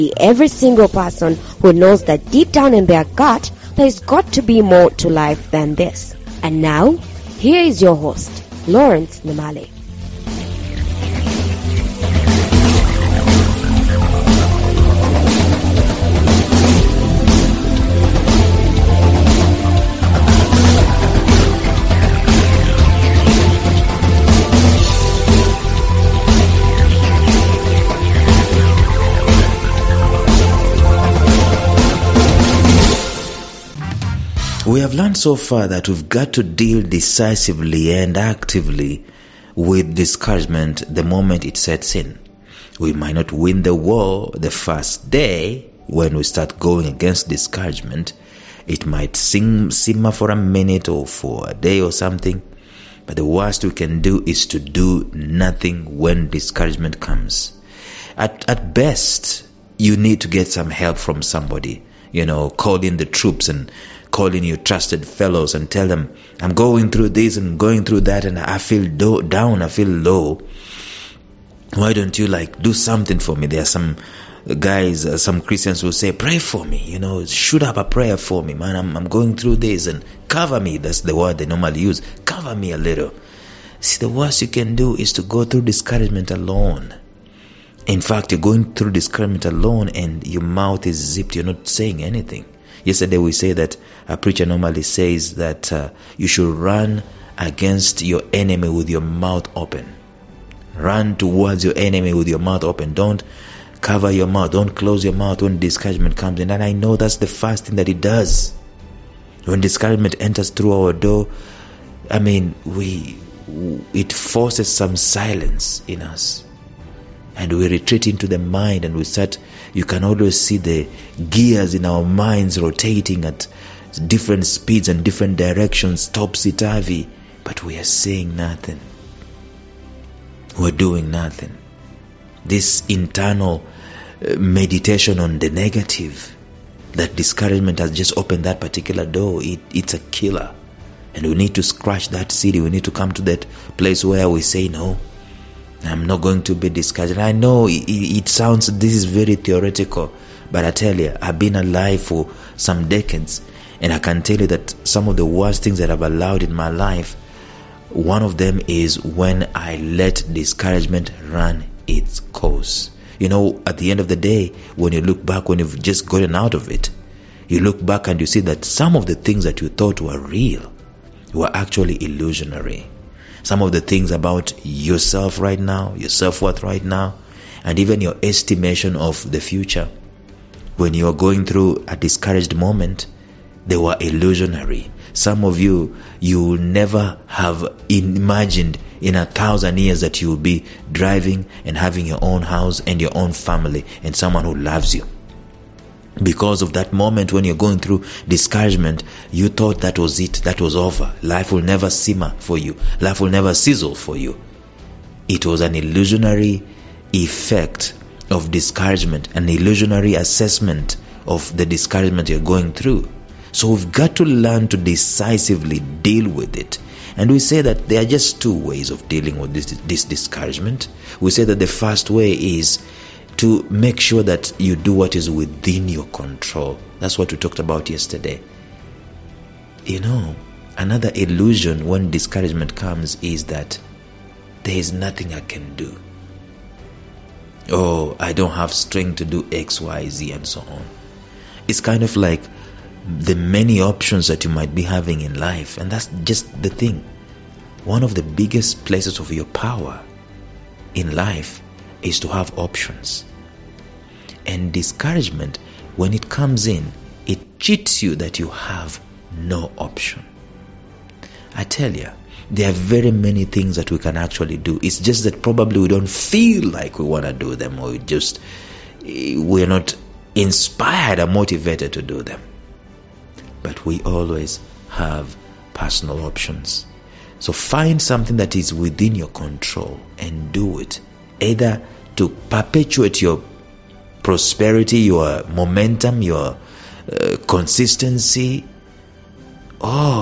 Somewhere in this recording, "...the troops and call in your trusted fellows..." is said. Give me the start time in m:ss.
1:02.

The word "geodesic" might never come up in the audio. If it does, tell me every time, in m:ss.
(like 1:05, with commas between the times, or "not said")
not said.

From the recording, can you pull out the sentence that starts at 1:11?
Why don't you like do something for me?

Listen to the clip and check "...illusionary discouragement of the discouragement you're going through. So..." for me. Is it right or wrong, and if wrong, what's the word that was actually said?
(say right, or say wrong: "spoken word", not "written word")
wrong: "assessment", not "discouragement".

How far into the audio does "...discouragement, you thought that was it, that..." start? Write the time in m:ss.
3:18.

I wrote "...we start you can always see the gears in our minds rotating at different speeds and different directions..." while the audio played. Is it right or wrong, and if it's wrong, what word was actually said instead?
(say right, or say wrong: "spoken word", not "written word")
right.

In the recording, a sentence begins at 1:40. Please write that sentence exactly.
Run towards your enemy with your mouth open.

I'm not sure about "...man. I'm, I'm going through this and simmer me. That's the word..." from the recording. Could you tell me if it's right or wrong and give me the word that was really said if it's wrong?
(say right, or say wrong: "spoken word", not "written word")
wrong: "cover", not "simmer".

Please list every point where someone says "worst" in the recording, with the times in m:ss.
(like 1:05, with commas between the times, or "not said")
0:53, 1:24, 2:35.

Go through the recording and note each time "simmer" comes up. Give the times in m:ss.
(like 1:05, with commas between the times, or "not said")
0:49, 3:21.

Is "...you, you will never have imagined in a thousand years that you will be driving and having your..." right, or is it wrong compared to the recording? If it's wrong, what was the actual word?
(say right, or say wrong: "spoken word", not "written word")
right.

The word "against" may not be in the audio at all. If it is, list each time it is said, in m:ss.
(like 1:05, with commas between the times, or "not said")
0:46, 1:37.